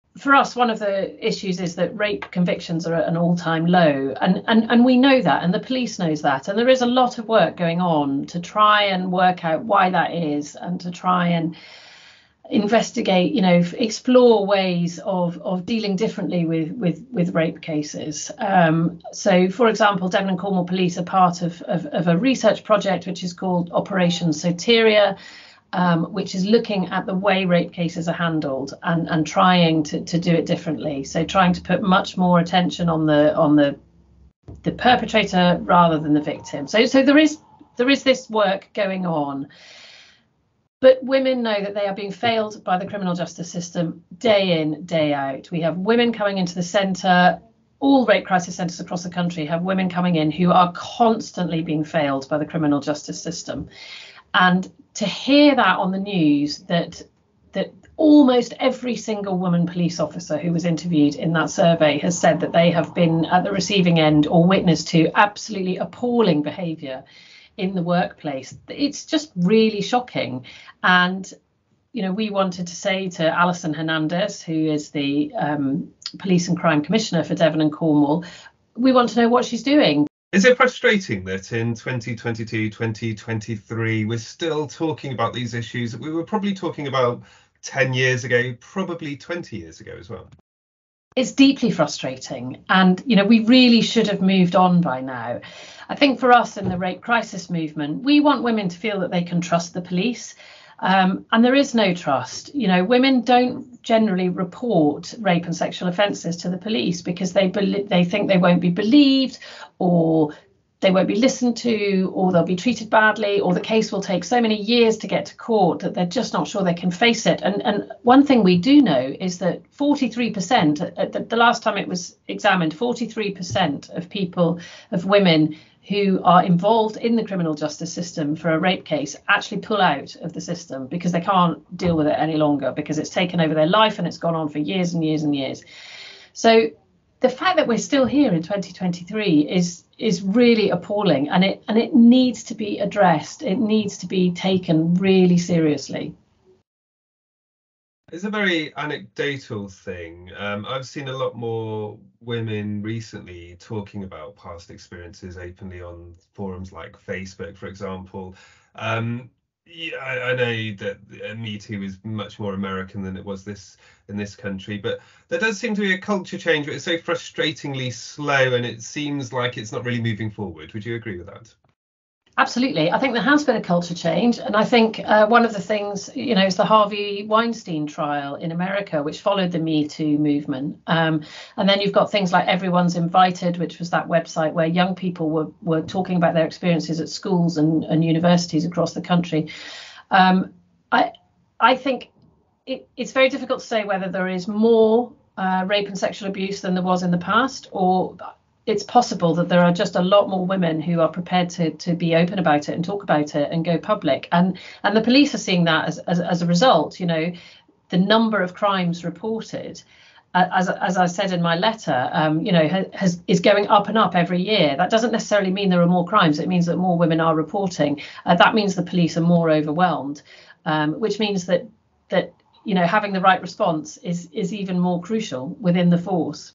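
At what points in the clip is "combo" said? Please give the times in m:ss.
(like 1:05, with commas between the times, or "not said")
not said.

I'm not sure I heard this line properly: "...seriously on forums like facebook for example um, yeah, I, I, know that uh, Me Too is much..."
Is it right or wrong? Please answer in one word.
wrong.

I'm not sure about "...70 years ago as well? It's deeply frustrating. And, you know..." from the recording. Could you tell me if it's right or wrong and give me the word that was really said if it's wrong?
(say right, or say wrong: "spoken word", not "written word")
wrong: "20", not "70".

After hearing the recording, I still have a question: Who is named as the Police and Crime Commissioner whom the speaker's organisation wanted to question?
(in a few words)
Alison Hernandez.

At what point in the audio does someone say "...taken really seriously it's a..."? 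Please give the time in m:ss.
2:24.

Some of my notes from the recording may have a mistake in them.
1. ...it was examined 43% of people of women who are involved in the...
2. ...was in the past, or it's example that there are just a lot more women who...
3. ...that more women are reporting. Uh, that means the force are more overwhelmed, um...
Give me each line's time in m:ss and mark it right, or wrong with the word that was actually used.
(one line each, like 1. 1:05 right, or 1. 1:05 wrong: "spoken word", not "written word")
1. 2:01 right
2. 3:16 wrong: "possible", not "example"
3. 3:36 wrong: "police", not "force".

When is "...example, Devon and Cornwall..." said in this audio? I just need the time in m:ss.
0:19.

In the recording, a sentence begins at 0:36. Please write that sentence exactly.
So so there is there is this work going on.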